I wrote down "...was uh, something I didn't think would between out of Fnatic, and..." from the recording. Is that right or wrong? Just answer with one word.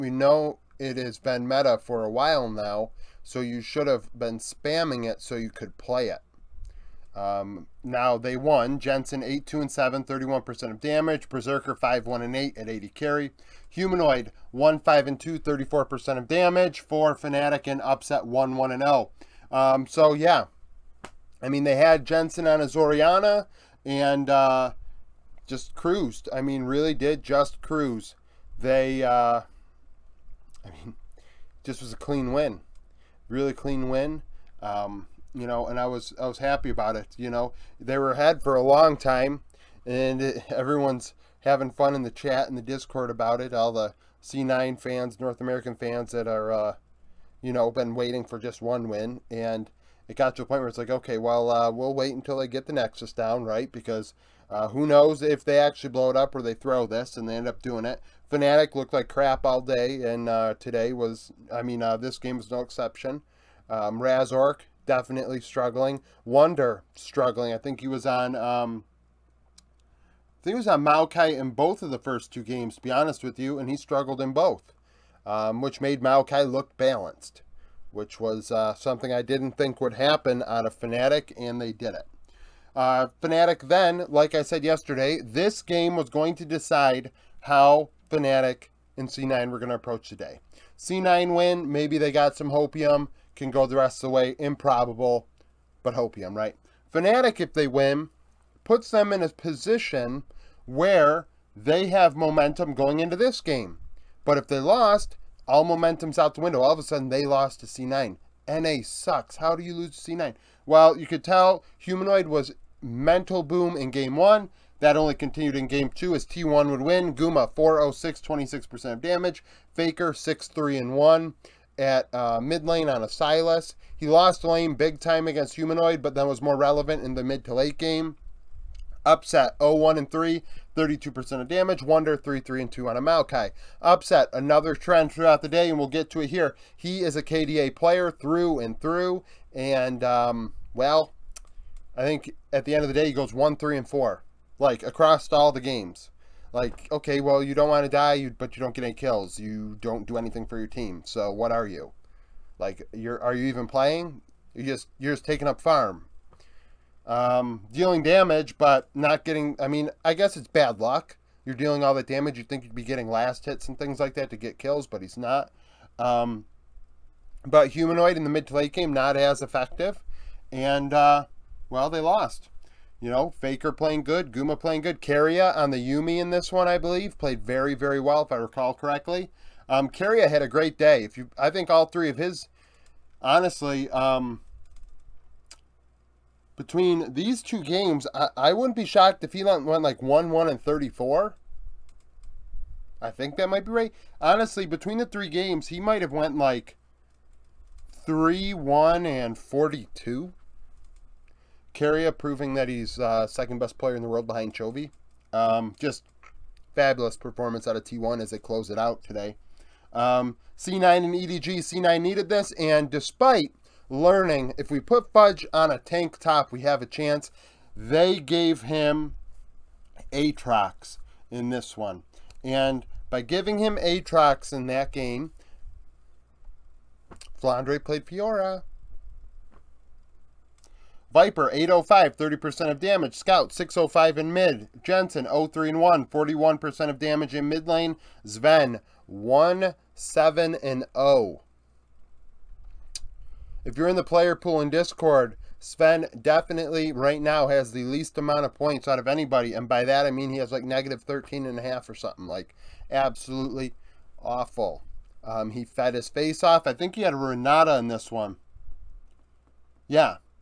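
wrong.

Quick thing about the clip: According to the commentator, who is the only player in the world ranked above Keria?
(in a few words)
Chovy.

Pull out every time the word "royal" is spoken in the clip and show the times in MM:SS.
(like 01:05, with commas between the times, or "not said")
not said.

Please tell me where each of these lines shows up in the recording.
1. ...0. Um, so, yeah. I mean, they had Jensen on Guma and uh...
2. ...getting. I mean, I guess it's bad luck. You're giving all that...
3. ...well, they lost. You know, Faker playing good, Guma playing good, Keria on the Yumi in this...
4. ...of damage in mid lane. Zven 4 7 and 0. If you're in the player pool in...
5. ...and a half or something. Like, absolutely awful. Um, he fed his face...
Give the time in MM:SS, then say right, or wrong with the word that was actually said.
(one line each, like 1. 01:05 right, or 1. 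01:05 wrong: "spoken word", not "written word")
1. 00:18 wrong: "Azoriana", not "Guma"
2. 02:39 wrong: "dealing", not "giving"
3. 02:51 right
4. 03:56 wrong: "1", not "4"
5. 04:11 right.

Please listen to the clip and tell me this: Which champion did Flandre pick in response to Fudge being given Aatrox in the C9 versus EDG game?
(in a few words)
Fiora.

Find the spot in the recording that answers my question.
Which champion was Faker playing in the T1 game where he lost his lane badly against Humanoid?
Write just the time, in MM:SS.
02:03.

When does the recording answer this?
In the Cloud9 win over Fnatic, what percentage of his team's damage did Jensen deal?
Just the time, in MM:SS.
00:10.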